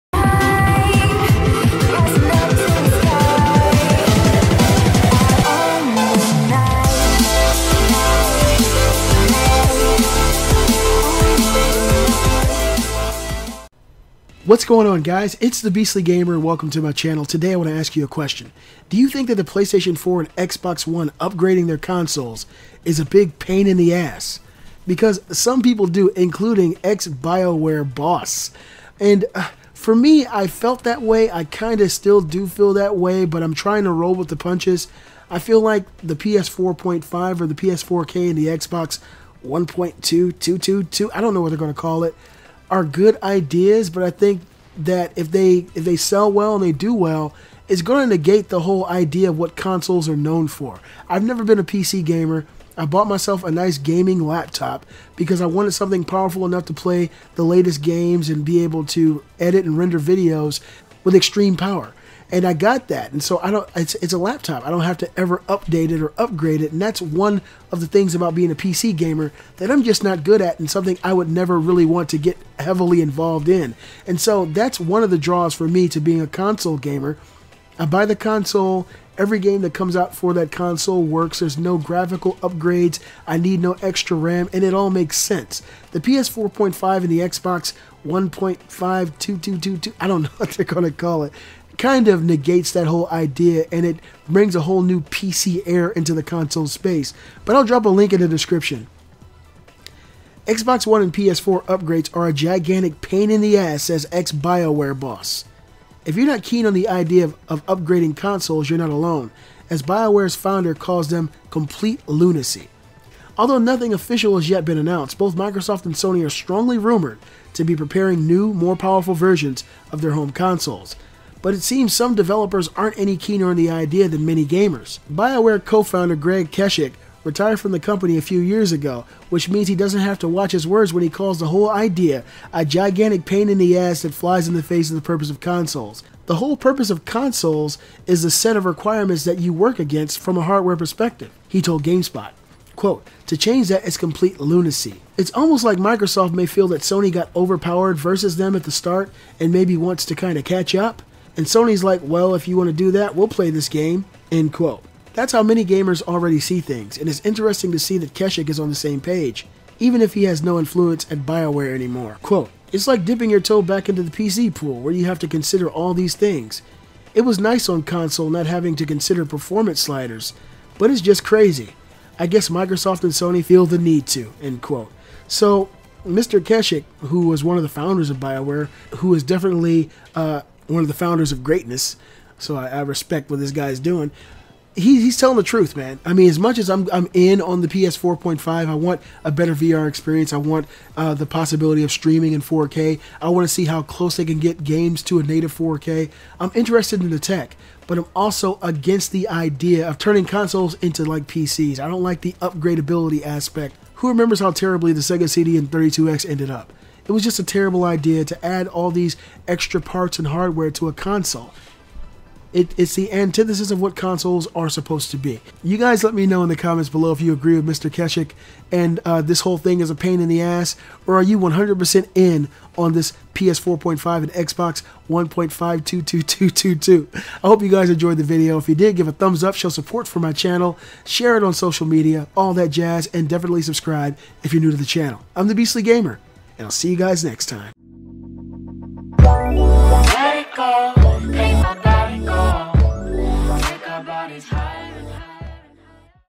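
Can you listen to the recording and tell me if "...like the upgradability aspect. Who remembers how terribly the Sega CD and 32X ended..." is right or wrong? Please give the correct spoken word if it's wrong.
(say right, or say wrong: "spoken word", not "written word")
right.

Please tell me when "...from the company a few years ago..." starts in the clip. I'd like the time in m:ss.
2:07.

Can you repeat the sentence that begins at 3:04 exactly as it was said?
He, he's telling the truth, man.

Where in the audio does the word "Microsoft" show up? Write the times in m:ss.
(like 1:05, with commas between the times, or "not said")
1:55, 2:25, 2:52.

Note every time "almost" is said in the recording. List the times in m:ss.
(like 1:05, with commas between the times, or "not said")
2:25.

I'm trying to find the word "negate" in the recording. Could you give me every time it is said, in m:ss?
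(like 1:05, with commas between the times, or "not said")
0:48, 1:32.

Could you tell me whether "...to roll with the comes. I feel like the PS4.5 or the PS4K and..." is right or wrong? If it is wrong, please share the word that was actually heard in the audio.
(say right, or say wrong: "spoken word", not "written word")
wrong: "punches", not "comes".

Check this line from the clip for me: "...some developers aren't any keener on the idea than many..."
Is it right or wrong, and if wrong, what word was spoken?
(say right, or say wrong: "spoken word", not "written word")
right.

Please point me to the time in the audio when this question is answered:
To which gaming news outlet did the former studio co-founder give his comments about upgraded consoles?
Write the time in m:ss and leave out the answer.
2:21.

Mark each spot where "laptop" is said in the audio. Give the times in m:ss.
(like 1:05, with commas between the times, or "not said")
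0:54, 1:04.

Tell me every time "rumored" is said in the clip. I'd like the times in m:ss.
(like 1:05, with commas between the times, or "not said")
1:56.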